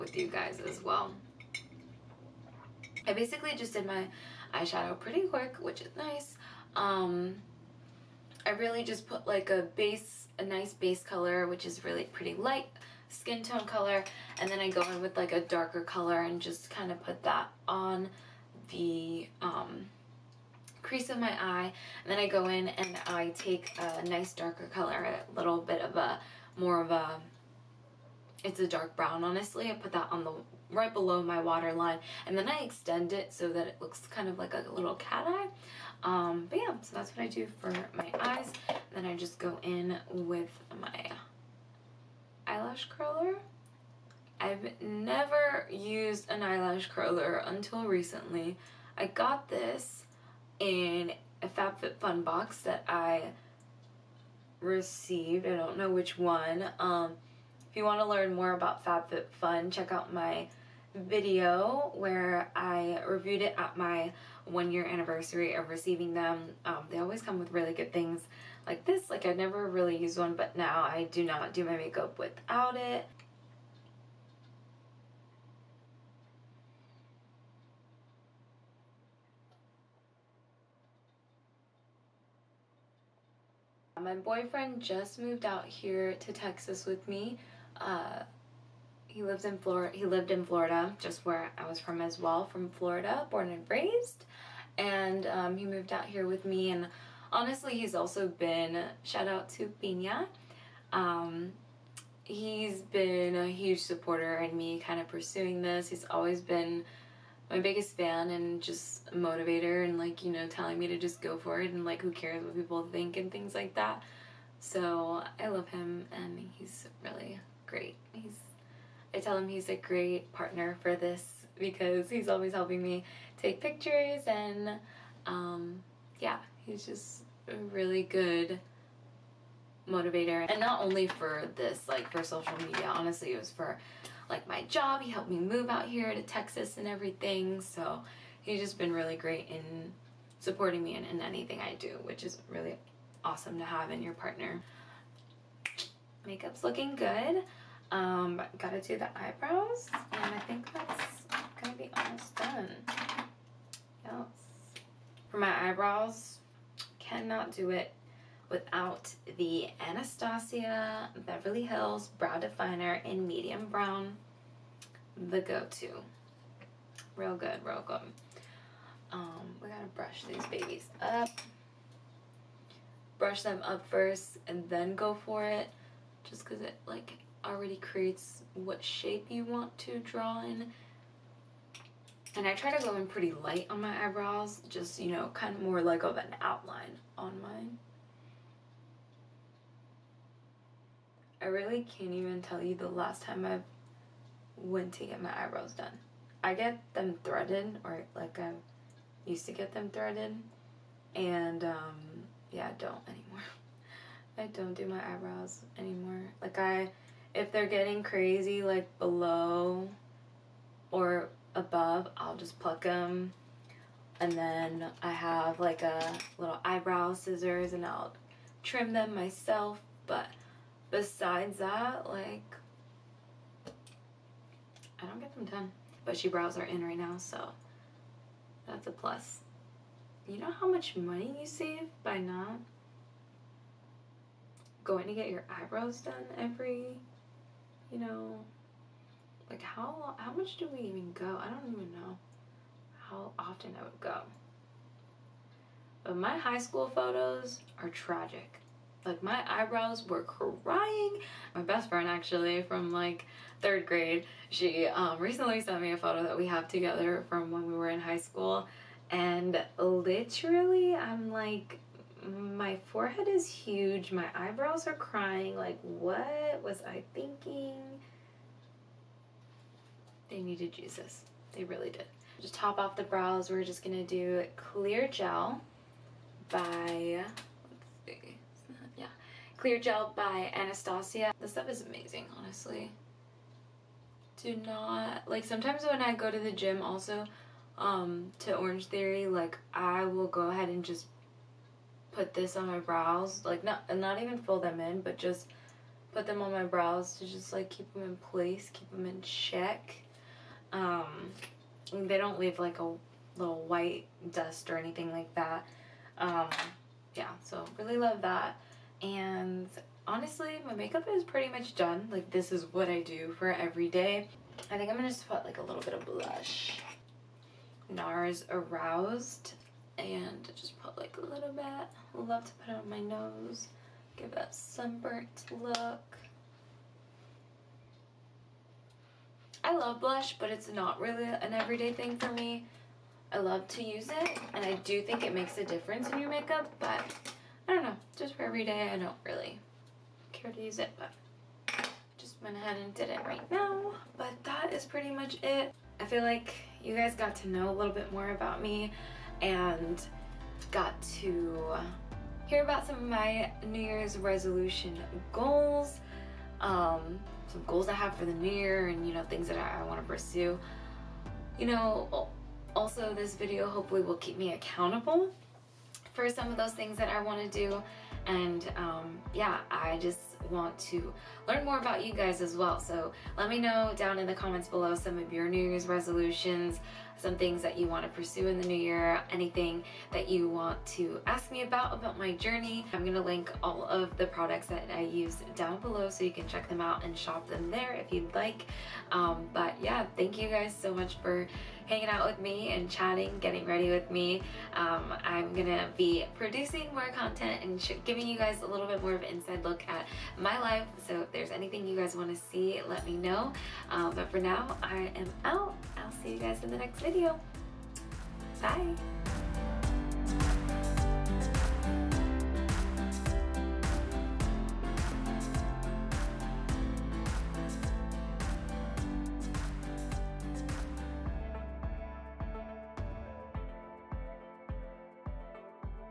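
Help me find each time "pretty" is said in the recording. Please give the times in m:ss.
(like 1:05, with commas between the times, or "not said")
0:04, 0:12, 3:03, 5:11, 5:44.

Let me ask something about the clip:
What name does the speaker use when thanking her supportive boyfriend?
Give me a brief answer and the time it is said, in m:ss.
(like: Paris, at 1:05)
Pina, at 1:39.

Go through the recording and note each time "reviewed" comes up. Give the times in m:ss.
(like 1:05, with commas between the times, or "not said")
1:03.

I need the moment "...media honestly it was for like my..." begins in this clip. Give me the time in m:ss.
2:12.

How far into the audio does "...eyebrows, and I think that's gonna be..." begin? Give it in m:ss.
2:29.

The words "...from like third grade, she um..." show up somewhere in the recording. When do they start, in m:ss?
4:12.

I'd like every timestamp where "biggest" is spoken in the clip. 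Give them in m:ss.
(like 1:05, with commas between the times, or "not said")
1:47.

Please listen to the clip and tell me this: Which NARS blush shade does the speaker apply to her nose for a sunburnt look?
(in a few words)
Aroused.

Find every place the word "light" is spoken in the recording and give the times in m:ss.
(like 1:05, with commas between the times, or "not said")
0:12, 3:03.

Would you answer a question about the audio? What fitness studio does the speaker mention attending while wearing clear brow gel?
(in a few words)
Orange Theory.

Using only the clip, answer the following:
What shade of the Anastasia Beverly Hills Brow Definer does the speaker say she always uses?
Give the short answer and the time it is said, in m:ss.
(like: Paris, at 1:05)
Medium brown, at 2:43.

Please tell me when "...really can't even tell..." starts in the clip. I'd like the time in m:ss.
3:11.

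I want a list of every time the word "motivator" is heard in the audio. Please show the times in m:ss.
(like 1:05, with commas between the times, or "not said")
1:49, 2:09.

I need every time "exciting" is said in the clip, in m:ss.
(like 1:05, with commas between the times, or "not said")
not said.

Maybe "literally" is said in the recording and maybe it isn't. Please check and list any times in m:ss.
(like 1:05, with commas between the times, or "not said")
4:19.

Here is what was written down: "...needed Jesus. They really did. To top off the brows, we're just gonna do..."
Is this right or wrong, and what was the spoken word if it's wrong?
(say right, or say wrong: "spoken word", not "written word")
right.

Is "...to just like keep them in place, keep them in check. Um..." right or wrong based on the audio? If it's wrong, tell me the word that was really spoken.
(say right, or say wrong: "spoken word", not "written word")
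right.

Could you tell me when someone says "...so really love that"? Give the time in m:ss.
5:07.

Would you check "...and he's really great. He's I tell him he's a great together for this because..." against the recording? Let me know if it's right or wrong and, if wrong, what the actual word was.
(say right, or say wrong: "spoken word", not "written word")
wrong: "partner", not "together".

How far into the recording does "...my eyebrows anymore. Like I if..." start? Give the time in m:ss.
3:24.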